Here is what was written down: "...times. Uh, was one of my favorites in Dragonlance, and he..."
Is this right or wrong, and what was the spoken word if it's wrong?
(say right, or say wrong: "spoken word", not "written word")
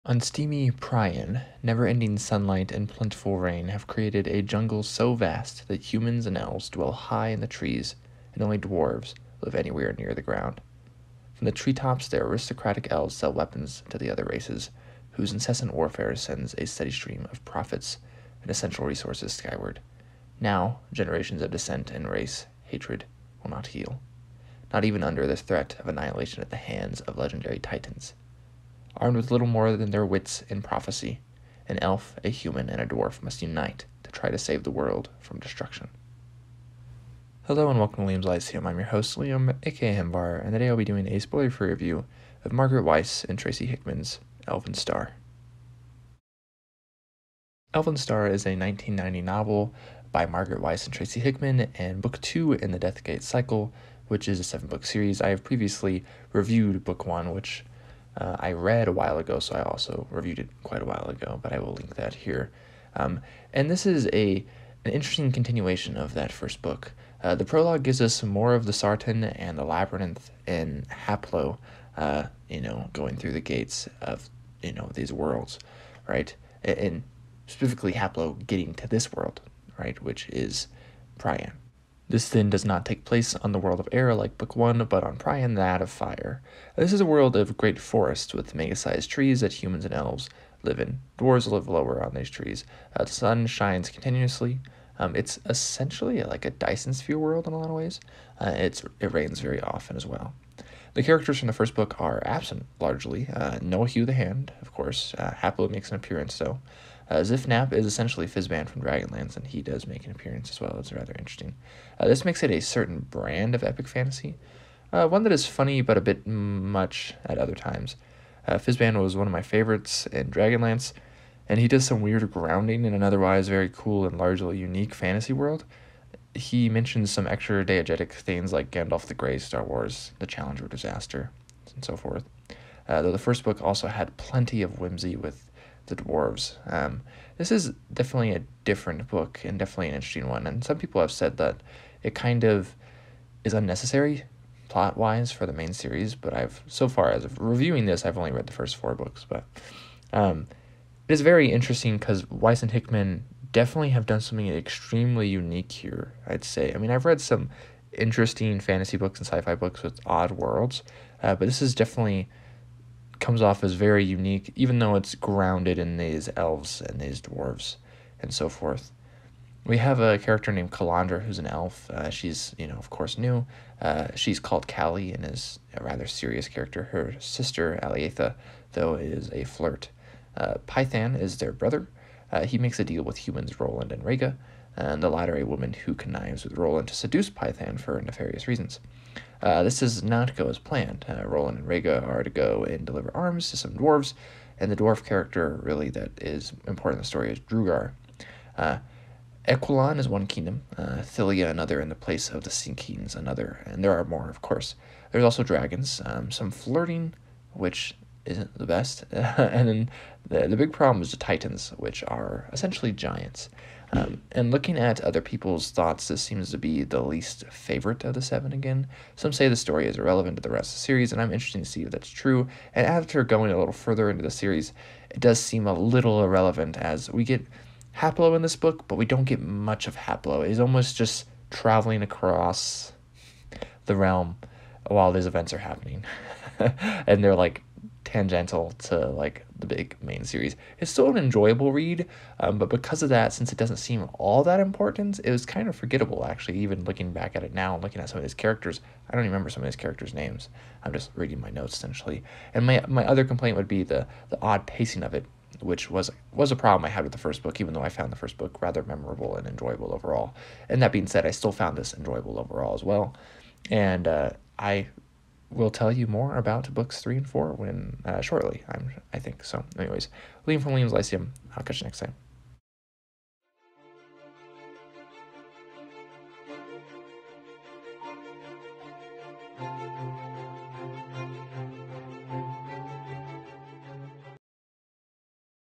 right.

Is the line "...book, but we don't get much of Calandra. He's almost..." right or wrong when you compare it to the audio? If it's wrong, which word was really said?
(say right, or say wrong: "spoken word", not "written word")
wrong: "Haplo", not "Calandra".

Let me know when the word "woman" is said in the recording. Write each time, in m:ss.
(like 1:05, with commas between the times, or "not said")
3:05.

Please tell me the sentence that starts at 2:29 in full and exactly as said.
But um, it is very interesting because Weis and Hickman definitely have done something extremely unique here.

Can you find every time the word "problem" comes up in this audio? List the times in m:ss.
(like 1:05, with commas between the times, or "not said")
3:30, 4:16.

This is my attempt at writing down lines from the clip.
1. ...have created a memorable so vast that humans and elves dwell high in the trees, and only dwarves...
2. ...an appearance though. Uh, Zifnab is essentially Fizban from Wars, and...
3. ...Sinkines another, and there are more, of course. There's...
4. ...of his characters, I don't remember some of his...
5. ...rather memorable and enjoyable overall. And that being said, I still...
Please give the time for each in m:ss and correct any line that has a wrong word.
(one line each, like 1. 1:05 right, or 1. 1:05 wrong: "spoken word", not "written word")
1. 0:03 wrong: "jungle", not "memorable"
2. 1:45 wrong: "Dragonlance", not "Wars"
3. 3:22 right
4. 4:08 right
5. 4:18 right.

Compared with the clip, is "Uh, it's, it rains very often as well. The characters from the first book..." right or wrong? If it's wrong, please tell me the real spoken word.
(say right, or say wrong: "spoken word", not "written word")
right.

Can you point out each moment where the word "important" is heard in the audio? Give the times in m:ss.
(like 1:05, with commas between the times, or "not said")
3:16, 4:04.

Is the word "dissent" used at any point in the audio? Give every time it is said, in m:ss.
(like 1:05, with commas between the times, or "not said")
0:21.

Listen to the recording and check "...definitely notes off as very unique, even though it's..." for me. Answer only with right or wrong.
wrong.